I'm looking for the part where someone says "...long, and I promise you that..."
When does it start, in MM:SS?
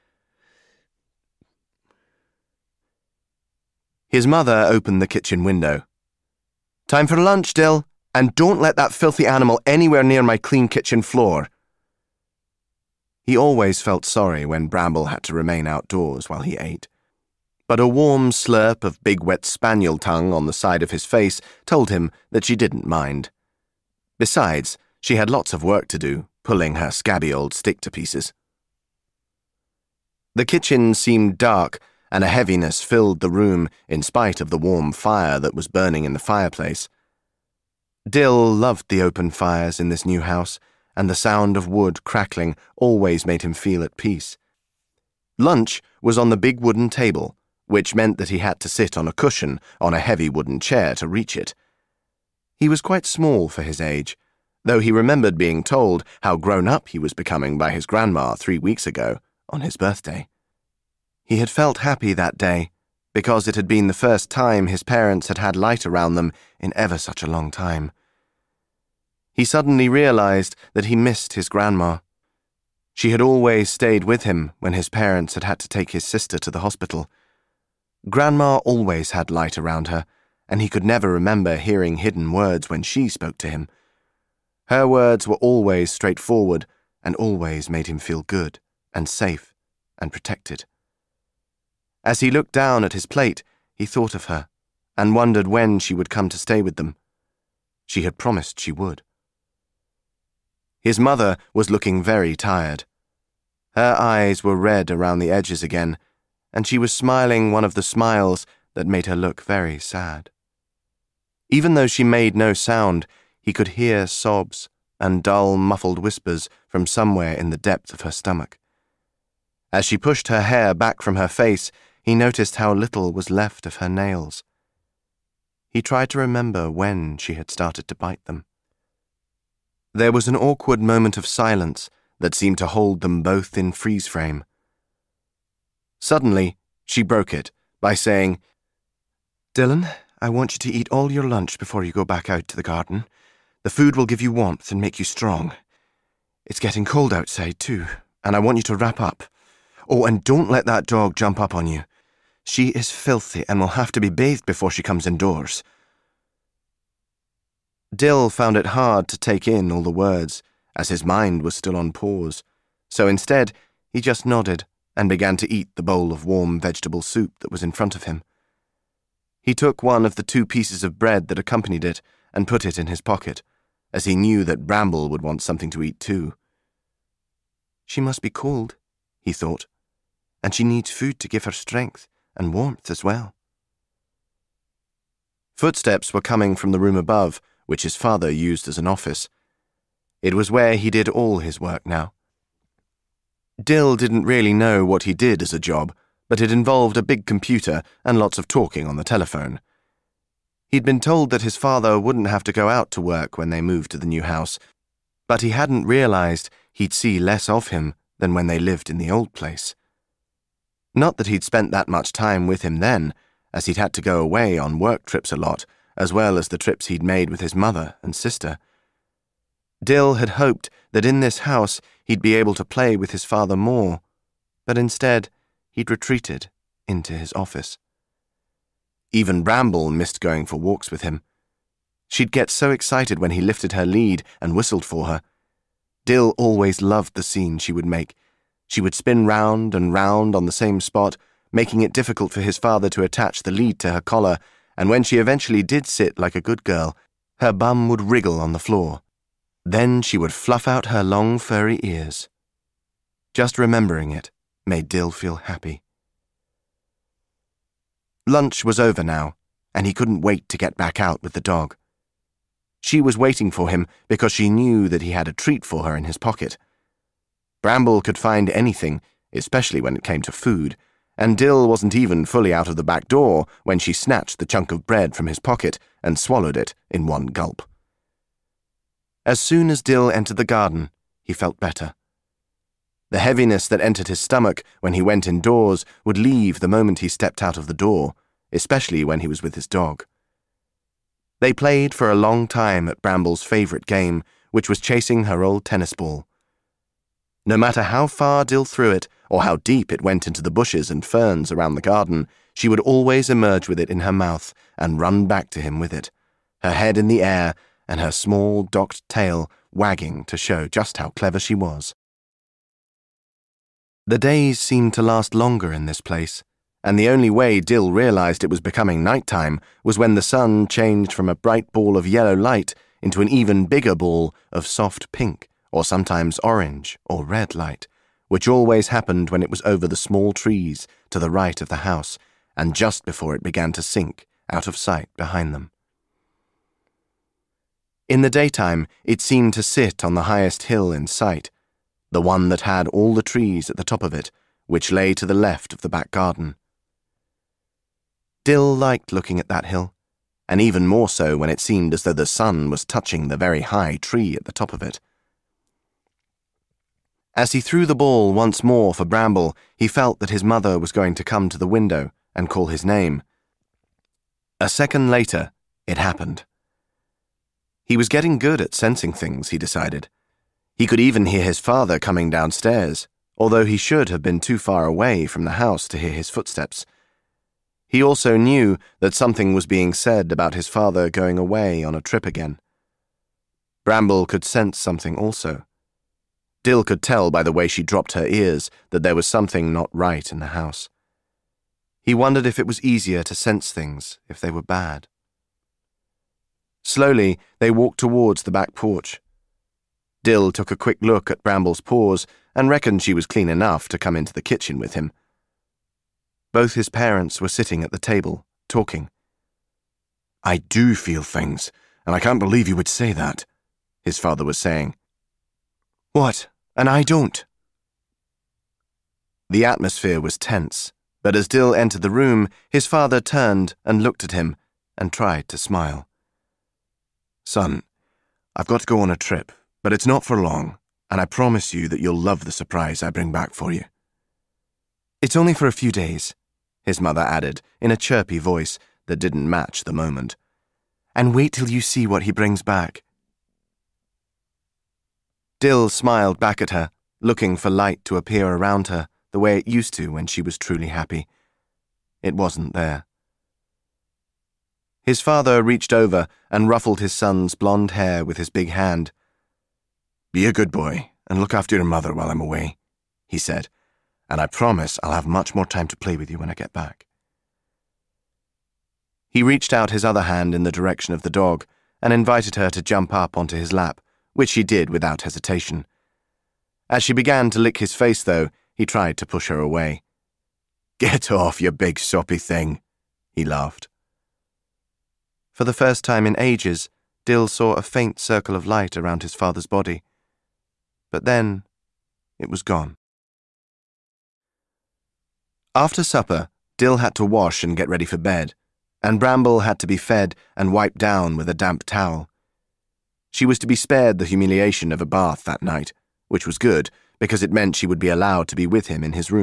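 07:10.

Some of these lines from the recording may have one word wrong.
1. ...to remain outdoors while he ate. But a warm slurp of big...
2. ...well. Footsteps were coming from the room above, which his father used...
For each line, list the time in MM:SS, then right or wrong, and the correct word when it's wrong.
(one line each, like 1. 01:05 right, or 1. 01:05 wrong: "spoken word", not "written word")
1. 00:15 right
2. 03:03 right.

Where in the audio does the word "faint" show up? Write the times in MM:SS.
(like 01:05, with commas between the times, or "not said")
08:07.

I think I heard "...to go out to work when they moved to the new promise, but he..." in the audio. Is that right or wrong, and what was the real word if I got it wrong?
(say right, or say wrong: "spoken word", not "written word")
wrong: "house", not "promise".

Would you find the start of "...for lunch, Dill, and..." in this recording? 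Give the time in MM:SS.
00:07.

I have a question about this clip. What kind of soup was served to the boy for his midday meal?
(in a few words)
vegetable soup.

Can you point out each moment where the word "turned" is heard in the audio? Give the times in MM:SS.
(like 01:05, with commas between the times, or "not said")
07:03.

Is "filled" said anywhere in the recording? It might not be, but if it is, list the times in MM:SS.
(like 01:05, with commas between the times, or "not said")
00:32.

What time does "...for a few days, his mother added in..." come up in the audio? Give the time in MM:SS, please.
07:15.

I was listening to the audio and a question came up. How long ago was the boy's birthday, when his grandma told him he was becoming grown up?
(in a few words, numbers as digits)
3 weeks.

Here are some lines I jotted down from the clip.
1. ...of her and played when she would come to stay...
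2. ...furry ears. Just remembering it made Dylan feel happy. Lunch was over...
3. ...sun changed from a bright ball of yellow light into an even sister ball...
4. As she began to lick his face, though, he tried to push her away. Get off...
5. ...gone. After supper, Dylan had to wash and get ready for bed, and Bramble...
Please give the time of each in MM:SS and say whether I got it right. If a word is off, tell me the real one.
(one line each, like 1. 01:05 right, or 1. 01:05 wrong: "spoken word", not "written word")
1. 01:34 wrong: "wondered", not "played"
2. 04:11 wrong: "Dill", not "Dylan"
3. 05:20 wrong: "bigger", not "sister"
4. 07:56 right
5. 08:12 wrong: "Dill", not "Dylan".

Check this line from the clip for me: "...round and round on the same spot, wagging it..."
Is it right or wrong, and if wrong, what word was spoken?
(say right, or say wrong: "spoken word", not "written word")
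wrong: "making", not "wagging".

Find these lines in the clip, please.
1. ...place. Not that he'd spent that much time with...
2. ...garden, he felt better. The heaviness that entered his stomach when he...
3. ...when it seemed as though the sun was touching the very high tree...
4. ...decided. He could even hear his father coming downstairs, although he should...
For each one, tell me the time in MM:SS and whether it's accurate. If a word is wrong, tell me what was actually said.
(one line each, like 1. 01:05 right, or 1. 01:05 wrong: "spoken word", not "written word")
1. 03:29 right
2. 04:40 right
3. 05:51 right
4. 06:09 right.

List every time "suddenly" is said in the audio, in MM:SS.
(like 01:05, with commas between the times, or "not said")
01:09, 02:15.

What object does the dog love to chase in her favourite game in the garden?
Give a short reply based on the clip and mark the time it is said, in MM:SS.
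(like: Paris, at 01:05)
tennis ball, at 04:55.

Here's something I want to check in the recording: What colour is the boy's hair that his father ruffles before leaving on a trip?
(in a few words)
blond.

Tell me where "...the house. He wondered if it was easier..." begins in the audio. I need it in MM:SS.
06:30.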